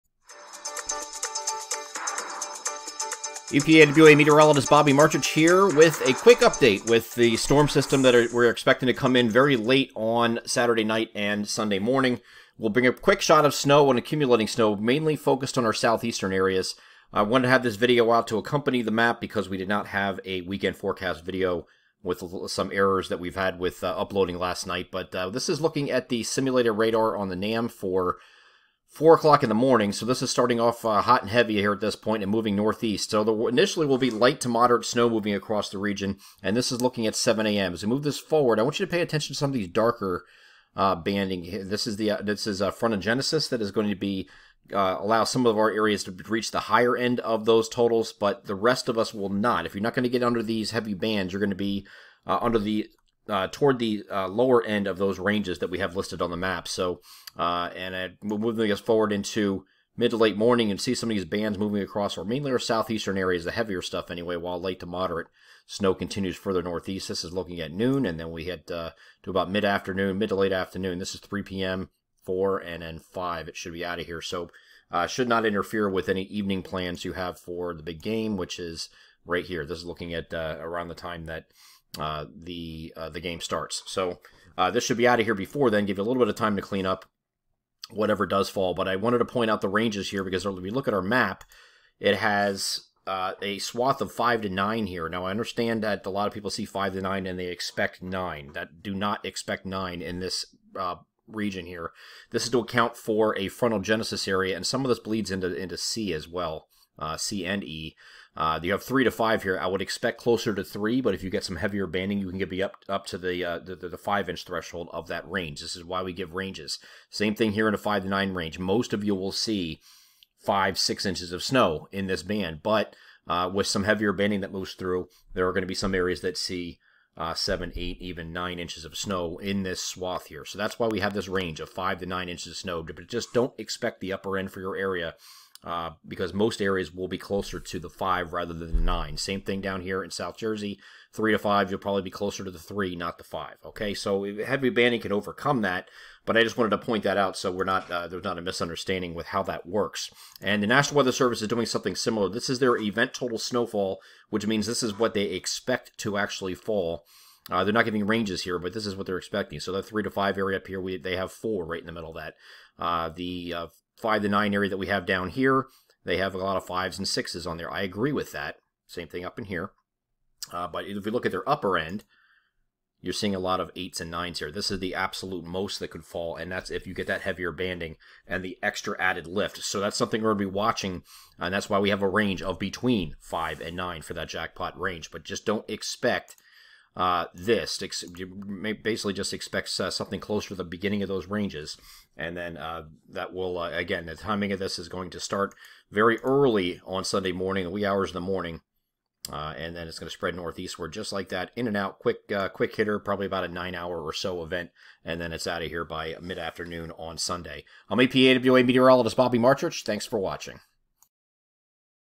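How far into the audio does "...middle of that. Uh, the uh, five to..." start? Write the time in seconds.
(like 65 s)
161 s.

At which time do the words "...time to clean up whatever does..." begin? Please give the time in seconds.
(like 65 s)
86 s.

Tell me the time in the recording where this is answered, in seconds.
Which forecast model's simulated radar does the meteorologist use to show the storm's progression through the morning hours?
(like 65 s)
27 s.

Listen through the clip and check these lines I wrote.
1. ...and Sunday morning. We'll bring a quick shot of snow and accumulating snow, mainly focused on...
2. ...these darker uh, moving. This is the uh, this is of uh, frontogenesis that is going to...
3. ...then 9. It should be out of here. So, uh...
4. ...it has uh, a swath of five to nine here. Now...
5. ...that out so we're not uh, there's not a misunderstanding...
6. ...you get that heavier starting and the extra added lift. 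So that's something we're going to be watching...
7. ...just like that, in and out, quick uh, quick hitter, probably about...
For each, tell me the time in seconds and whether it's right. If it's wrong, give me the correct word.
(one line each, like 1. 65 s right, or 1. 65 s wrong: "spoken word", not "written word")
1. 11 s right
2. 39 s wrong: "banding", not "moving"
3. 72 s wrong: "5", not "9"
4. 91 s right
5. 147 s right
6. 176 s wrong: "banding", not "starting"
7. 200 s right.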